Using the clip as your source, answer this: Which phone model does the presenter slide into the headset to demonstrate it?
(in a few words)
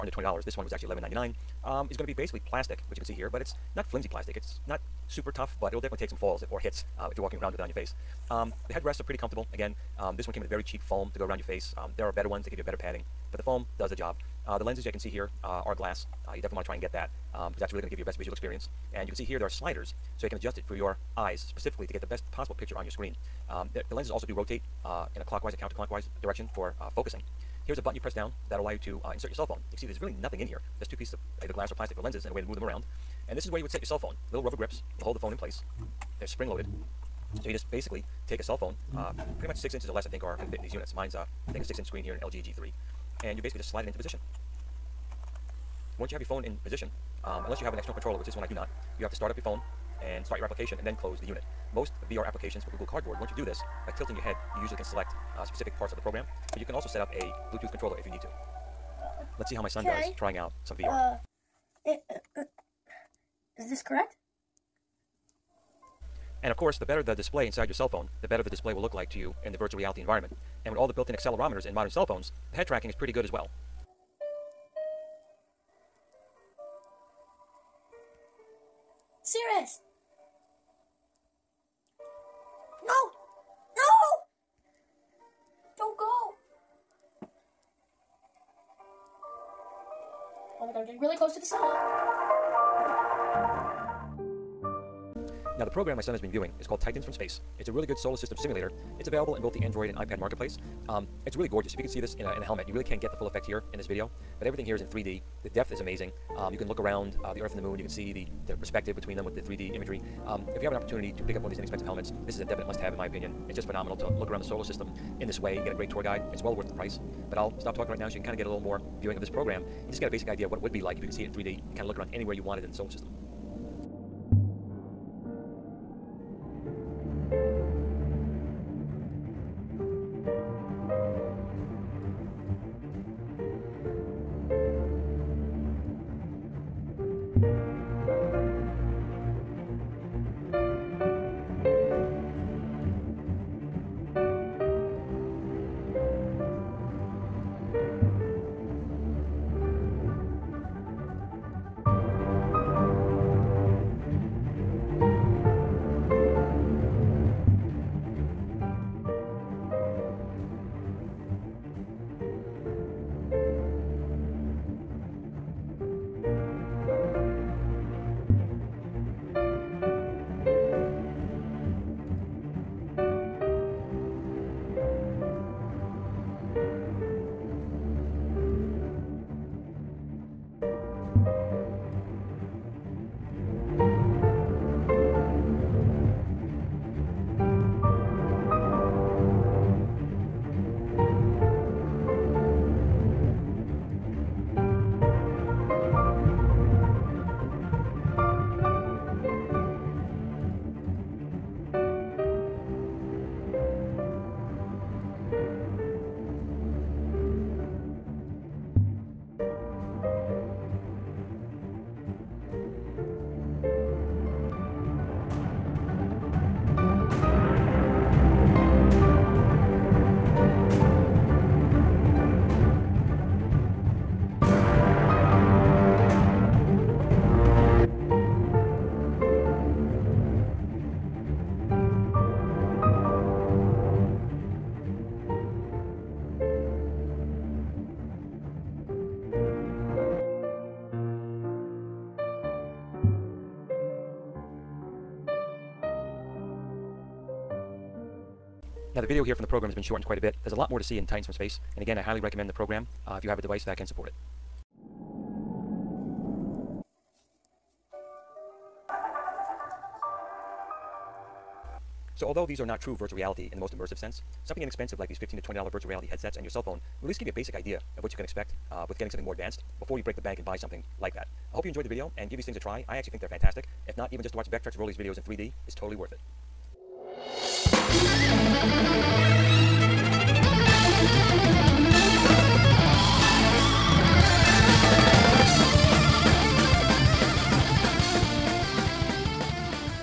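LG G3.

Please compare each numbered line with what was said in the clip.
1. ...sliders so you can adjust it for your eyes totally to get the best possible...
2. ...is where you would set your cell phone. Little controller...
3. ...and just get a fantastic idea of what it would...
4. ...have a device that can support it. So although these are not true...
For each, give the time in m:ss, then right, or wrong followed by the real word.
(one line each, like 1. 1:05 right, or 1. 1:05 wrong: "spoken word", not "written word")
1. 0:19 wrong: "specifically", not "totally"
2. 0:33 wrong: "rubber", not "controller"
3. 1:59 wrong: "basic", not "fantastic"
4. 4:13 right.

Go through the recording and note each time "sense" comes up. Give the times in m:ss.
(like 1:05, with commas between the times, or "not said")
4:23.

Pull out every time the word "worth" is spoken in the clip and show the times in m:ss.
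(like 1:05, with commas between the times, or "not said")
1:56, 4:35.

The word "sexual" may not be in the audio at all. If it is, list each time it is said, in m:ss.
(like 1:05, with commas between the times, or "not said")
not said.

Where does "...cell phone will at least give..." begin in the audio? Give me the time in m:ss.
4:26.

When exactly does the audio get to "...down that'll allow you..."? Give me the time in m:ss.
0:28.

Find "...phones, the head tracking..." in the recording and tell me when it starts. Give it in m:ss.
1:12.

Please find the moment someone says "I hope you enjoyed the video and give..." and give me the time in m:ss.
4:31.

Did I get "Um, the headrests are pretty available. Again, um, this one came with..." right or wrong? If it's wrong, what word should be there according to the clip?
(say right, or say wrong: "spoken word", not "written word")
wrong: "comfortable", not "available".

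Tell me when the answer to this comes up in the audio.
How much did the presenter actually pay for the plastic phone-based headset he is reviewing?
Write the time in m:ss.
0:00.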